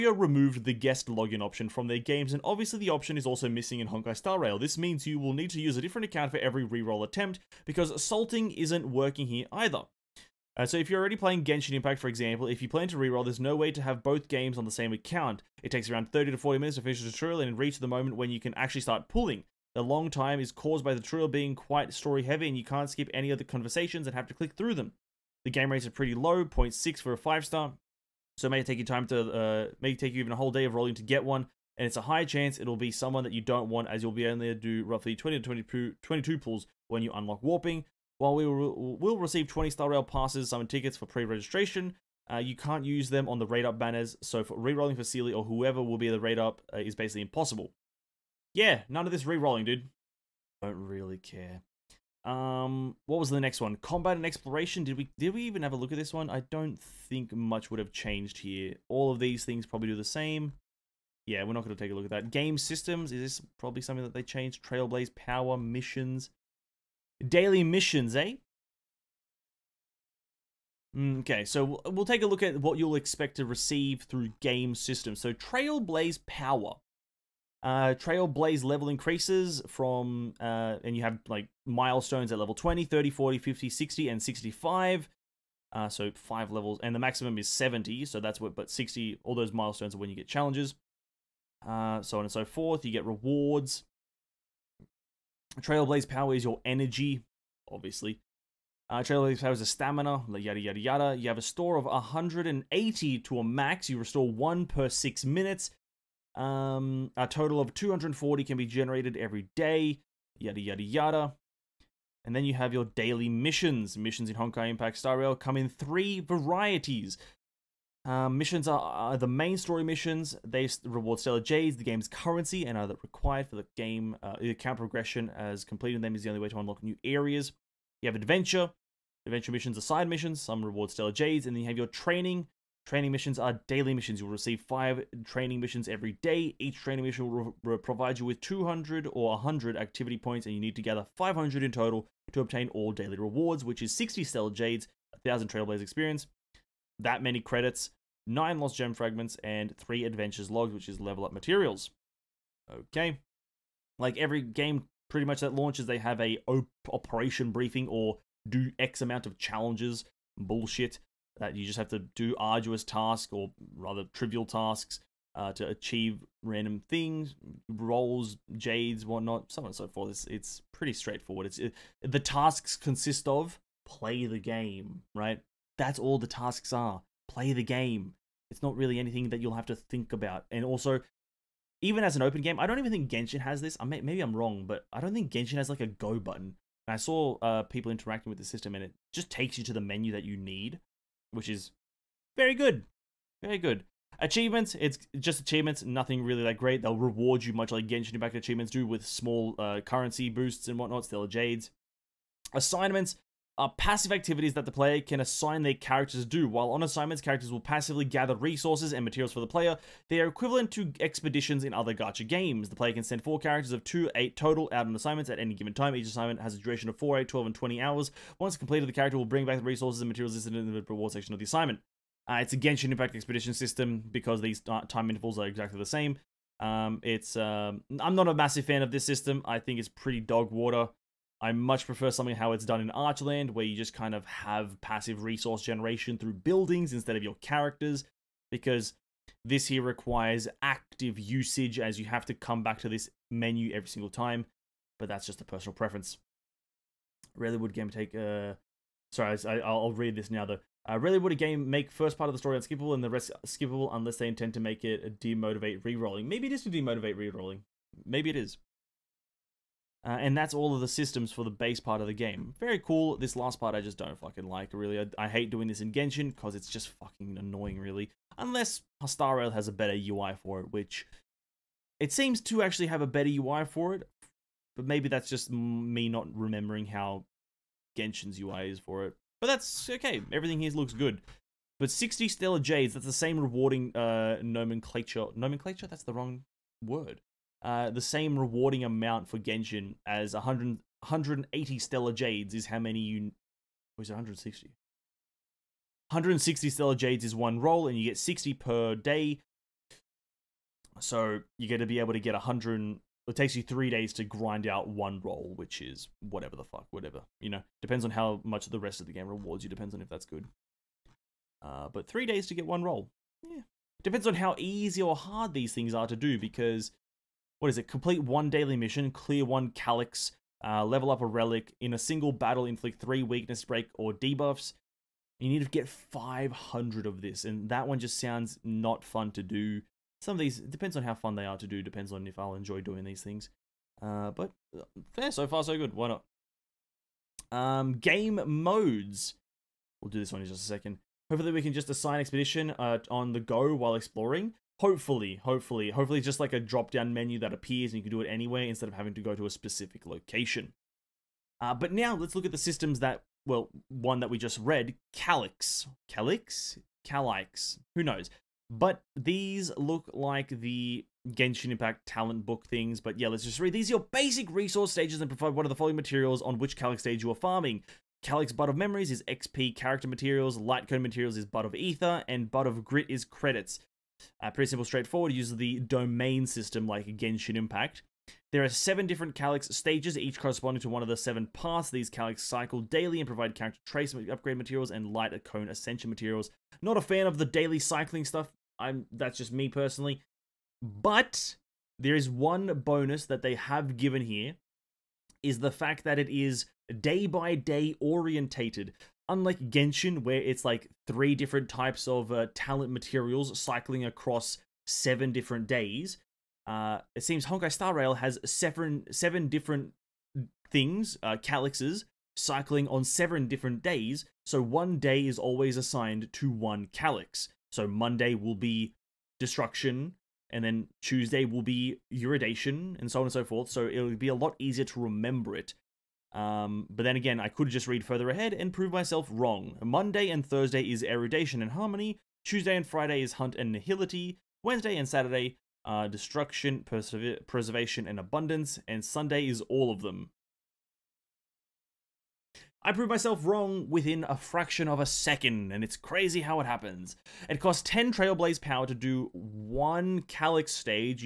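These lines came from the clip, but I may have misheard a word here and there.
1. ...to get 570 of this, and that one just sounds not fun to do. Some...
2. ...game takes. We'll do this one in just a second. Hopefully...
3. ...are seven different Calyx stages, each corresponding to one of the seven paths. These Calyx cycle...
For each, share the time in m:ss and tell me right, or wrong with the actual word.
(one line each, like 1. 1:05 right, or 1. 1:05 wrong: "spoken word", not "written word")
1. 5:25 wrong: "500", not "570"
2. 5:37 wrong: "modes", not "takes"
3. 6:18 right.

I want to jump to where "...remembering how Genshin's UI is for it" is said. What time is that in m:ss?
4:36.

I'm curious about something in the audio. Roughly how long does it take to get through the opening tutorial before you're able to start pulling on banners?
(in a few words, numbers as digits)
30 to 40 minutes.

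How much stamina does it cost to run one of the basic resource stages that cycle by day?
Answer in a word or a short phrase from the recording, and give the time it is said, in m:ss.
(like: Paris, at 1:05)
10 Trailblaze power, at 7:27.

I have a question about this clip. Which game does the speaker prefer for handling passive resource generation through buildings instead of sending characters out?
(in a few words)
Archland.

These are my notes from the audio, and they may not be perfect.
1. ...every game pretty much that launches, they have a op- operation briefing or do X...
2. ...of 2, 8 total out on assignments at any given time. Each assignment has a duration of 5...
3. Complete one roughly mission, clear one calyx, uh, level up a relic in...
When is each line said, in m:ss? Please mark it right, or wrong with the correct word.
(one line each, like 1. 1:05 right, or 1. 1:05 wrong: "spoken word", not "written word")
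1. 2:34 right
2. 3:33 wrong: "4", not "5"
3. 5:17 wrong: "daily", not "roughly".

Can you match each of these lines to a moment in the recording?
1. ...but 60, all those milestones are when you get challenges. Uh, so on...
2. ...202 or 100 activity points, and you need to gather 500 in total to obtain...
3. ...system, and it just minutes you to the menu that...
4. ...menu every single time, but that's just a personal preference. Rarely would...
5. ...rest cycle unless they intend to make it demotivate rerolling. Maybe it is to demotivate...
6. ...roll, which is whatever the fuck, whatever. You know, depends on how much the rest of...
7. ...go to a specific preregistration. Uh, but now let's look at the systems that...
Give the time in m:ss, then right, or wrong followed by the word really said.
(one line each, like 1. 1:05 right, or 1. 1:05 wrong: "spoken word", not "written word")
1. 1:28 right
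2. 2:18 wrong: "200", not "202"
3. 3:08 wrong: "takes", not "minutes"
4. 4:03 right
5. 4:13 wrong: "skippable", not "cycle"
6. 5:05 right
7. 5:49 wrong: "location", not "preregistration".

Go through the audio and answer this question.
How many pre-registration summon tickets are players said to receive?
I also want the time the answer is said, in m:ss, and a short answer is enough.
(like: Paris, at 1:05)
20, at 0:39.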